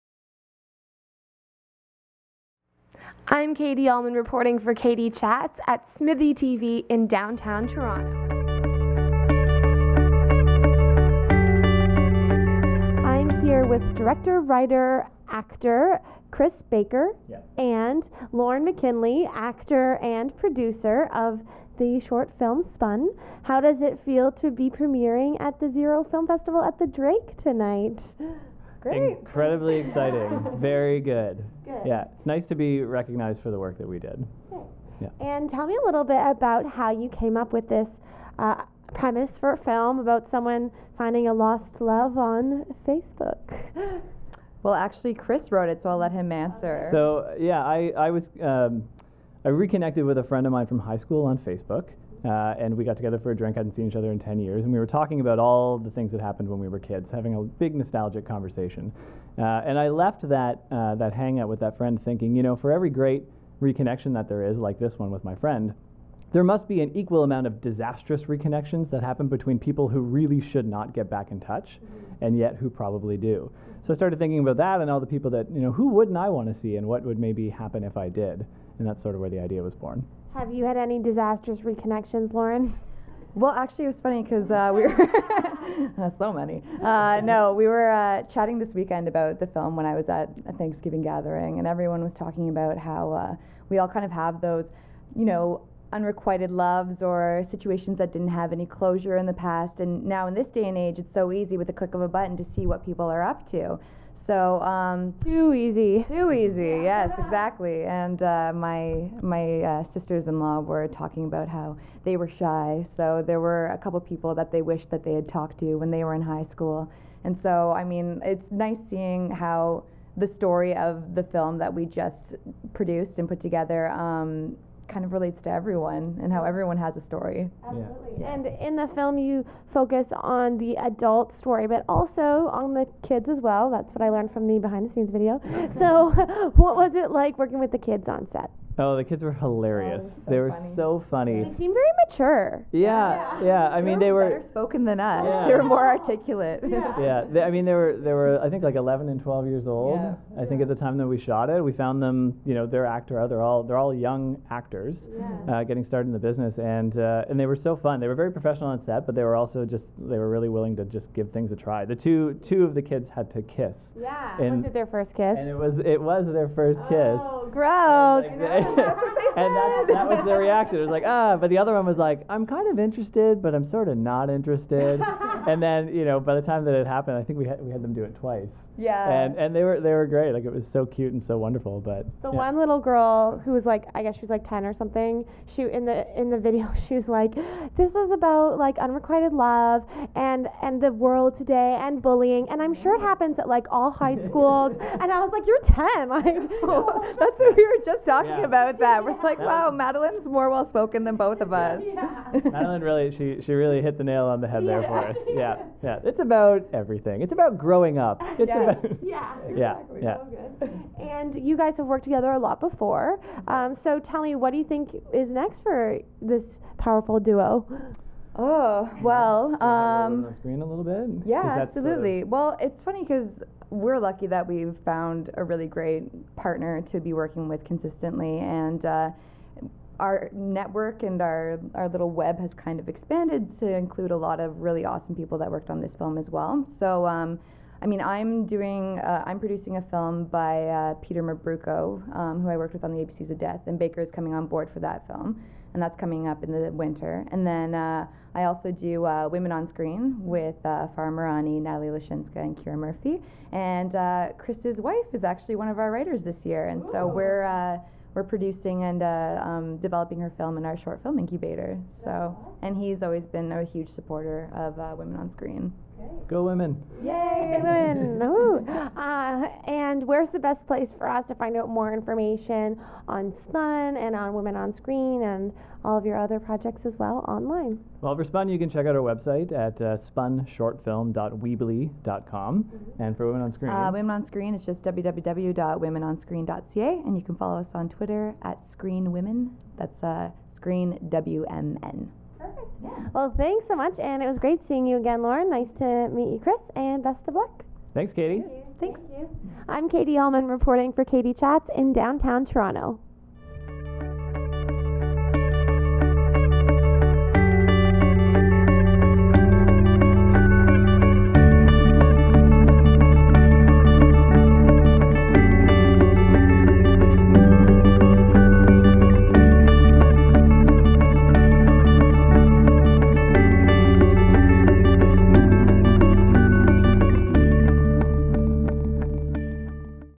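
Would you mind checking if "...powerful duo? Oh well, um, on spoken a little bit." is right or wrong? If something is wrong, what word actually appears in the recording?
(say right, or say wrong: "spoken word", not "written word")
wrong: "screen", not "spoken".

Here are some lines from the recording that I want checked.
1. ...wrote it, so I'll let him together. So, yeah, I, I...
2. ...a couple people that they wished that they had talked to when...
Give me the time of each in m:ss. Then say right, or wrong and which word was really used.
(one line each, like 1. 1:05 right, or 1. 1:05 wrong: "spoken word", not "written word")
1. 0:45 wrong: "answer", not "together"
2. 1:53 right.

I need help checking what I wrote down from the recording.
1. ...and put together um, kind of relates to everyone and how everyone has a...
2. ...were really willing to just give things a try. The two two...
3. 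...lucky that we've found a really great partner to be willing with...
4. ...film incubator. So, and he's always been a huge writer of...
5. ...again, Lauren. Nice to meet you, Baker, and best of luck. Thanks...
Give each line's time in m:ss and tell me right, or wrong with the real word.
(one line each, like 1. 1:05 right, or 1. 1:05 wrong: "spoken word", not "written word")
1. 2:03 right
2. 2:40 right
3. 3:43 wrong: "working", not "willing"
4. 4:21 wrong: "supporter", not "writer"
5. 4:54 wrong: "Chris", not "Baker".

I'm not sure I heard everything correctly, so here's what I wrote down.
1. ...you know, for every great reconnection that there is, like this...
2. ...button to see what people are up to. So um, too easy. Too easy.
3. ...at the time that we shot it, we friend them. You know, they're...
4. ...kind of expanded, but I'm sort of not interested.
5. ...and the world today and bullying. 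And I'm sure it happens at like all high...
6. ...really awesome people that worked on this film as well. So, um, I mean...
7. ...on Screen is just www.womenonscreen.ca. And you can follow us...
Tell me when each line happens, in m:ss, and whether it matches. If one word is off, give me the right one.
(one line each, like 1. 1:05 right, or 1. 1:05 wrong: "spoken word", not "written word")
1. 1:02 right
2. 1:42 right
3. 2:30 wrong: "found", not "friend"
4. 2:52 wrong: "interested", not "expanded"
5. 3:10 right
6. 3:54 right
7. 4:44 right.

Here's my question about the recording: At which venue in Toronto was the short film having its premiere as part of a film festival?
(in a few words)
the Drake.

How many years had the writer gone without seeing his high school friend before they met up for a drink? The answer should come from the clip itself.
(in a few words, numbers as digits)
10.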